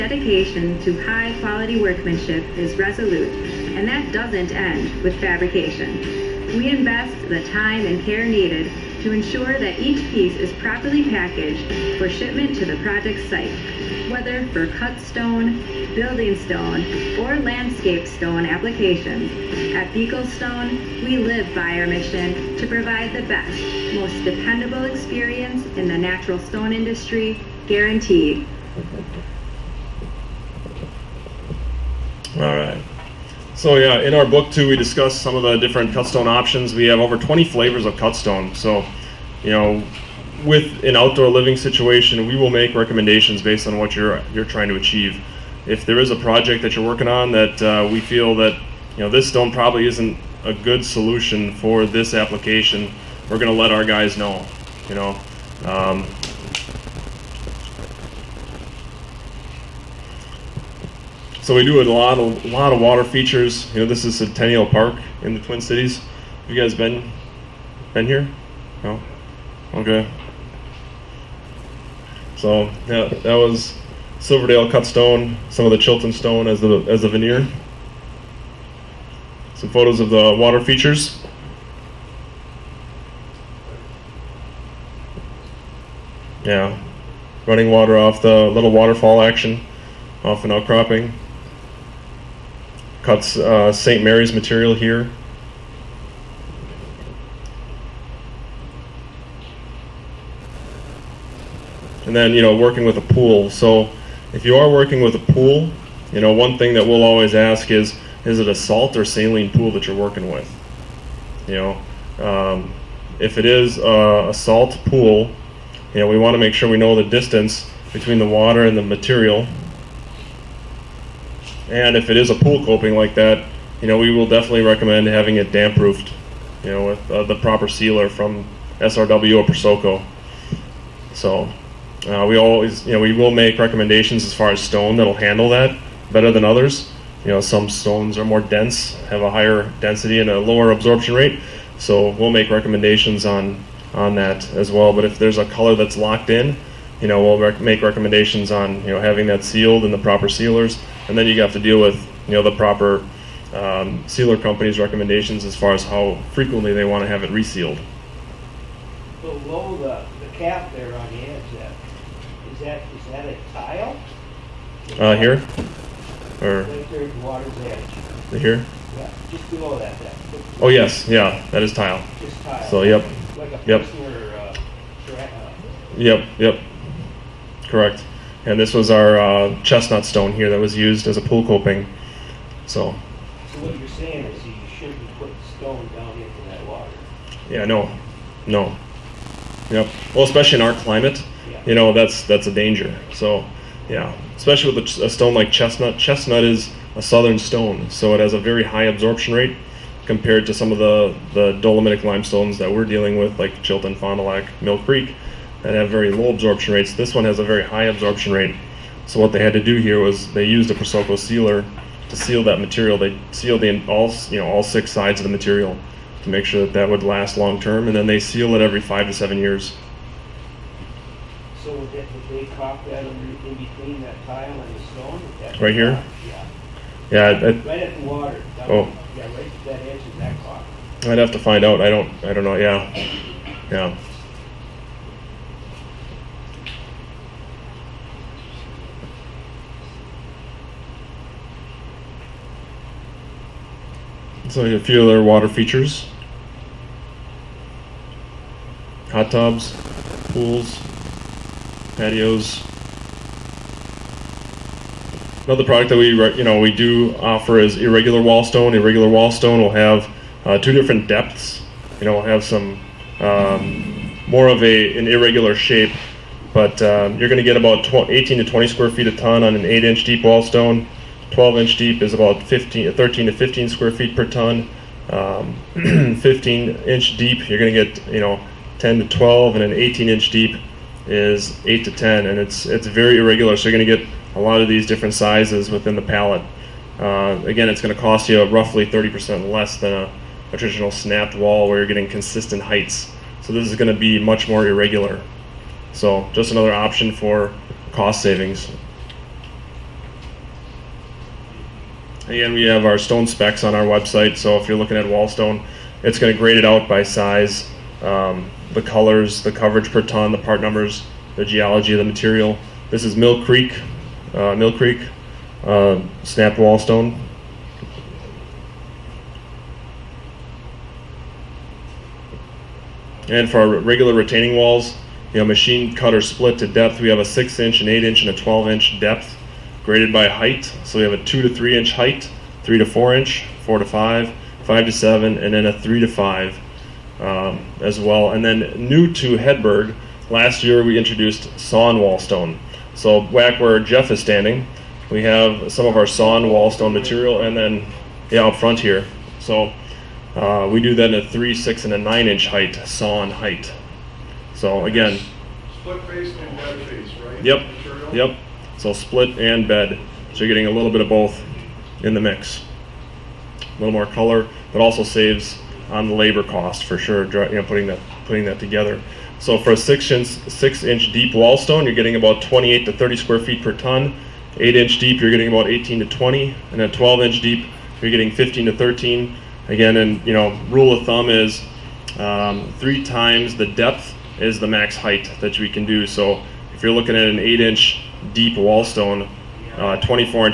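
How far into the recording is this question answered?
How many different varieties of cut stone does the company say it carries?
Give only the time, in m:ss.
0:36.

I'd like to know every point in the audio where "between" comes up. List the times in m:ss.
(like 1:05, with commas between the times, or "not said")
1:57, 3:43.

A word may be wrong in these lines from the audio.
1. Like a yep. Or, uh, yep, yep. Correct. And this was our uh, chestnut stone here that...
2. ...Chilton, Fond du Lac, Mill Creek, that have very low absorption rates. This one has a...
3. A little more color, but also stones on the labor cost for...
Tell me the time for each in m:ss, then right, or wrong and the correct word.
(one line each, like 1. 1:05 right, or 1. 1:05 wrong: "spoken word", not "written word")
1. 2:53 right
2. 3:23 right
3. 6:03 wrong: "saves", not "stones".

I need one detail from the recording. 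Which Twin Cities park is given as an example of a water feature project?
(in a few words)
Centennial Park.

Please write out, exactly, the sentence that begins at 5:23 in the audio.
And for our regular retaining walls, you know, machine cut or split to depth.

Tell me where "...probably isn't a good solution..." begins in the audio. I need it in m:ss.
0:49.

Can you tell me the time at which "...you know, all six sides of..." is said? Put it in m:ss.
3:34.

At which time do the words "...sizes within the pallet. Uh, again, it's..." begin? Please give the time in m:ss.
4:45.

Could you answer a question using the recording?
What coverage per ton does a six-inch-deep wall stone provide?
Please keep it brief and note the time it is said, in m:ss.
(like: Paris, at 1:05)
28 to 30 square feet, at 6:12.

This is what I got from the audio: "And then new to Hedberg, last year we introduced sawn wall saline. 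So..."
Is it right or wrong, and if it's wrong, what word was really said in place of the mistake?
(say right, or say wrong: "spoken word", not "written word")
wrong: "stone", not "saline".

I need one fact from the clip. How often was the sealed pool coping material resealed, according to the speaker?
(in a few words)
every 5 to 7 years.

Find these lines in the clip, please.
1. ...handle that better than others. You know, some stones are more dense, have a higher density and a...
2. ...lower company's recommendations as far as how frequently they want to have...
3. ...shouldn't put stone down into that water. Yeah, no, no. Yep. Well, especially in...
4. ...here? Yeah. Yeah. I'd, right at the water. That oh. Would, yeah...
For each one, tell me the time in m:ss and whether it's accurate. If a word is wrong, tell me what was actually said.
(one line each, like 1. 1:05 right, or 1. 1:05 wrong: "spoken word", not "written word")
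1. 2:15 right
2. 2:34 wrong: "sealer", not "lower"
3. 3:04 right
4. 3:45 right.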